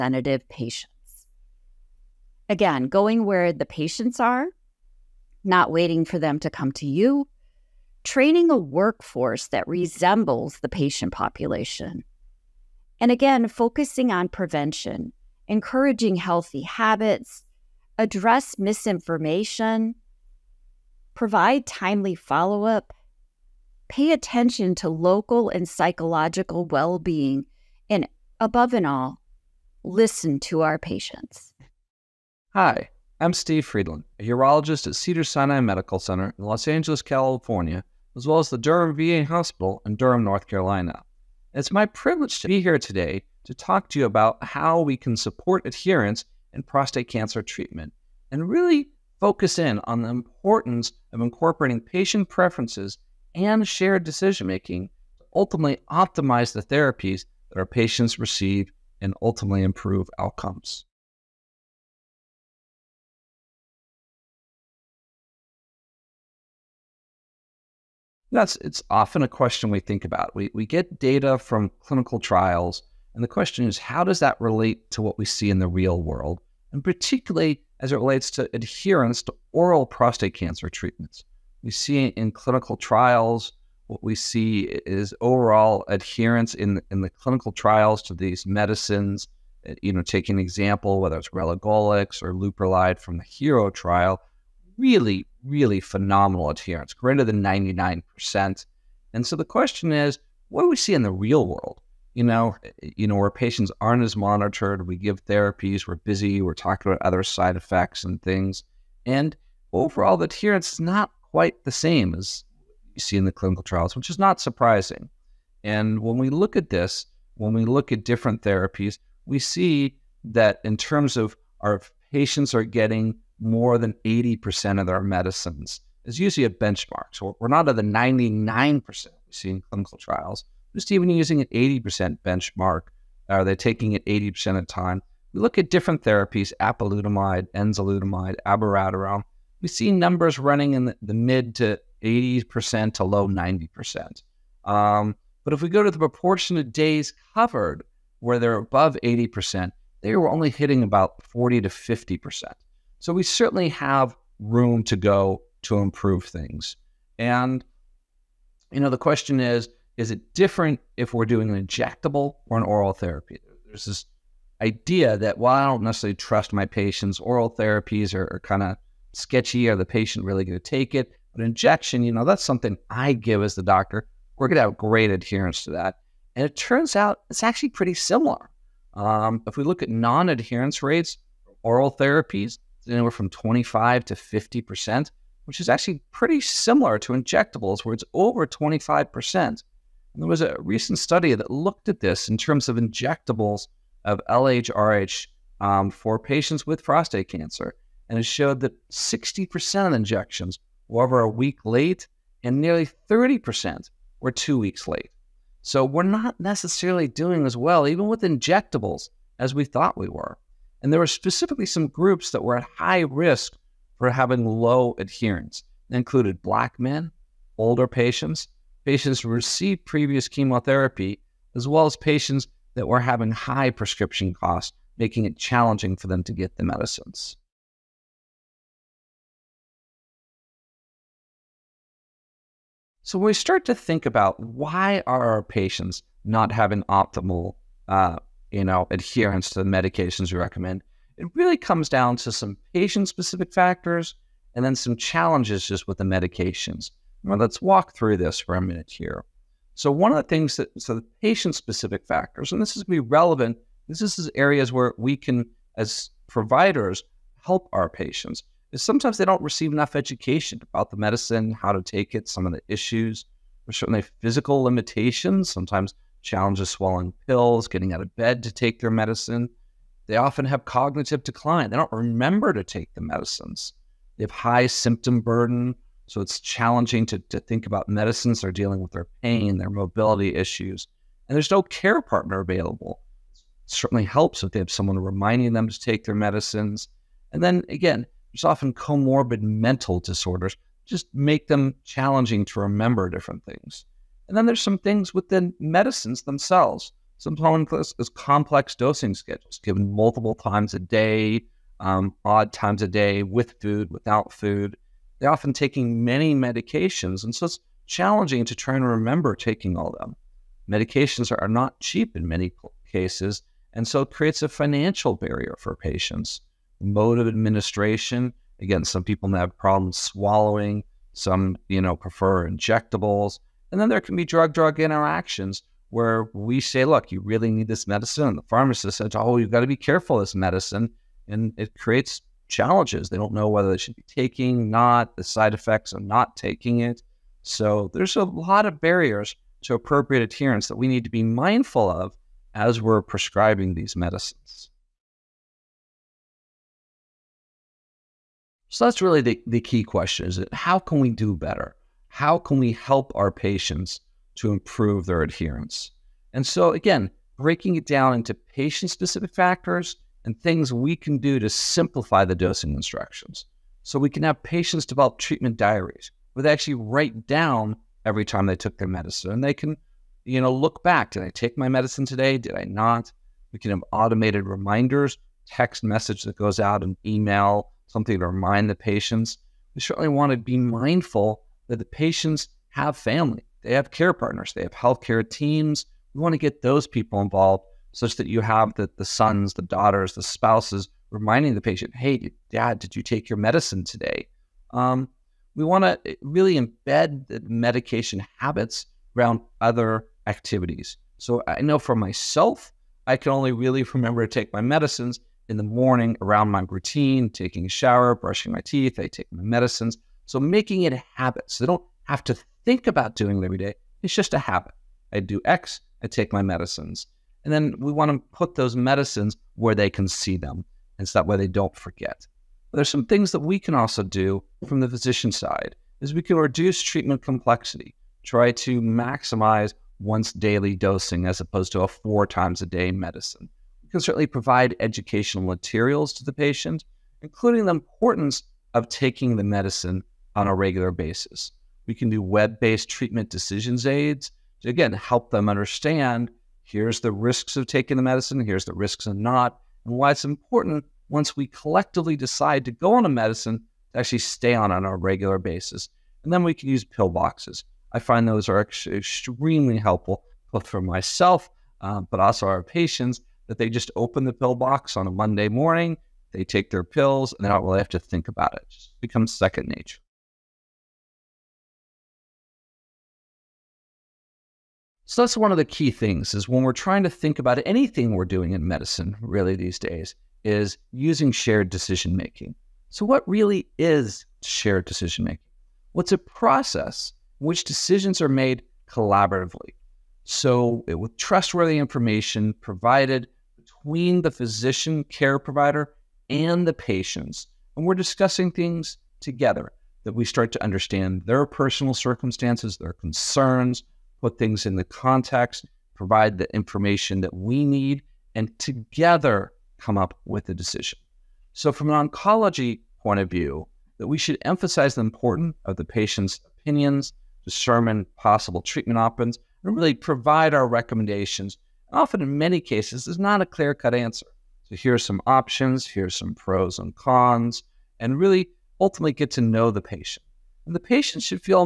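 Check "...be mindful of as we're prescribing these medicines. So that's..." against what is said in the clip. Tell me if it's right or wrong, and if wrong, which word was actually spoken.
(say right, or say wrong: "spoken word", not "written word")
right.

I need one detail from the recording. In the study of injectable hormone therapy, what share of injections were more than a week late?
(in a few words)
60%.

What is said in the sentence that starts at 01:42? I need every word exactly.
You know, you know, where patients aren't as monitored, we give therapies, we're busy, we're talking about other side effects and things.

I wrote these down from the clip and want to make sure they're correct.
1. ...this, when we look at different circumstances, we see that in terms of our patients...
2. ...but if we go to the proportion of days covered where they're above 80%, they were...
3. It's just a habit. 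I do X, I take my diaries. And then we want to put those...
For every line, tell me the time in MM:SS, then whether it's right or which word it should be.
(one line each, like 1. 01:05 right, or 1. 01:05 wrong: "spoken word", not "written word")
1. 01:56 wrong: "therapies", not "circumstances"
2. 02:25 right
3. 06:54 wrong: "medicines", not "diaries".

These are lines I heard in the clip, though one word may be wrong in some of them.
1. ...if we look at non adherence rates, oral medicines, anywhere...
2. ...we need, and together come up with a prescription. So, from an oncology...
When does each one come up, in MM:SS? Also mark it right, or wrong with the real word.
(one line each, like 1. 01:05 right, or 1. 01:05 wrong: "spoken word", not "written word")
1. 02:59 wrong: "therapies", not "medicines"
2. 08:27 wrong: "decision", not "prescription".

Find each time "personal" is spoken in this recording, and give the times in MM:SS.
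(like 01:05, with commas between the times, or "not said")
08:21.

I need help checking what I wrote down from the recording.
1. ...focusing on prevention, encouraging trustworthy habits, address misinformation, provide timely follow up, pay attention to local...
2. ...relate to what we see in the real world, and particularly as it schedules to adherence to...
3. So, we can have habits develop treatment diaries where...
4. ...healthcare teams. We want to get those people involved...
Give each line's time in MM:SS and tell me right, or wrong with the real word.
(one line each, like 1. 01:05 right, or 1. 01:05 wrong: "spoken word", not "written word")
1. 00:13 wrong: "healthy", not "trustworthy"
2. 01:14 wrong: "relates", not "schedules"
3. 06:03 wrong: "patients", not "habits"
4. 06:24 right.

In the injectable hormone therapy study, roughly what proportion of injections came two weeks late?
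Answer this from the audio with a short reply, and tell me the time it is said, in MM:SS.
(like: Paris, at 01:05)
nearly 30%, at 03:22.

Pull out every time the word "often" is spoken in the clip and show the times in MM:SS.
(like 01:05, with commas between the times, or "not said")
01:08, 04:30, 04:48, 05:05, 08:41.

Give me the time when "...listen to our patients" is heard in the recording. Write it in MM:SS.
00:29.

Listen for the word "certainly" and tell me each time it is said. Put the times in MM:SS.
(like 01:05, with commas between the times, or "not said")
02:33, 04:23, 04:43, 06:19, 07:14.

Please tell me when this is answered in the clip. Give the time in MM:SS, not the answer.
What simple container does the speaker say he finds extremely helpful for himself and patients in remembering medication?
07:36.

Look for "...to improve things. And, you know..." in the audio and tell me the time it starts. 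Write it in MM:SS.
02:35.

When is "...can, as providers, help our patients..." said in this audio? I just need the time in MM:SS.
04:15.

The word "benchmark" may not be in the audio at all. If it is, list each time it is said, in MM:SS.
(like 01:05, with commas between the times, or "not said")
02:06, 02:12.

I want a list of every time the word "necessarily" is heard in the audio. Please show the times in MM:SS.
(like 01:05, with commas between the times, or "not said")
02:45, 03:26.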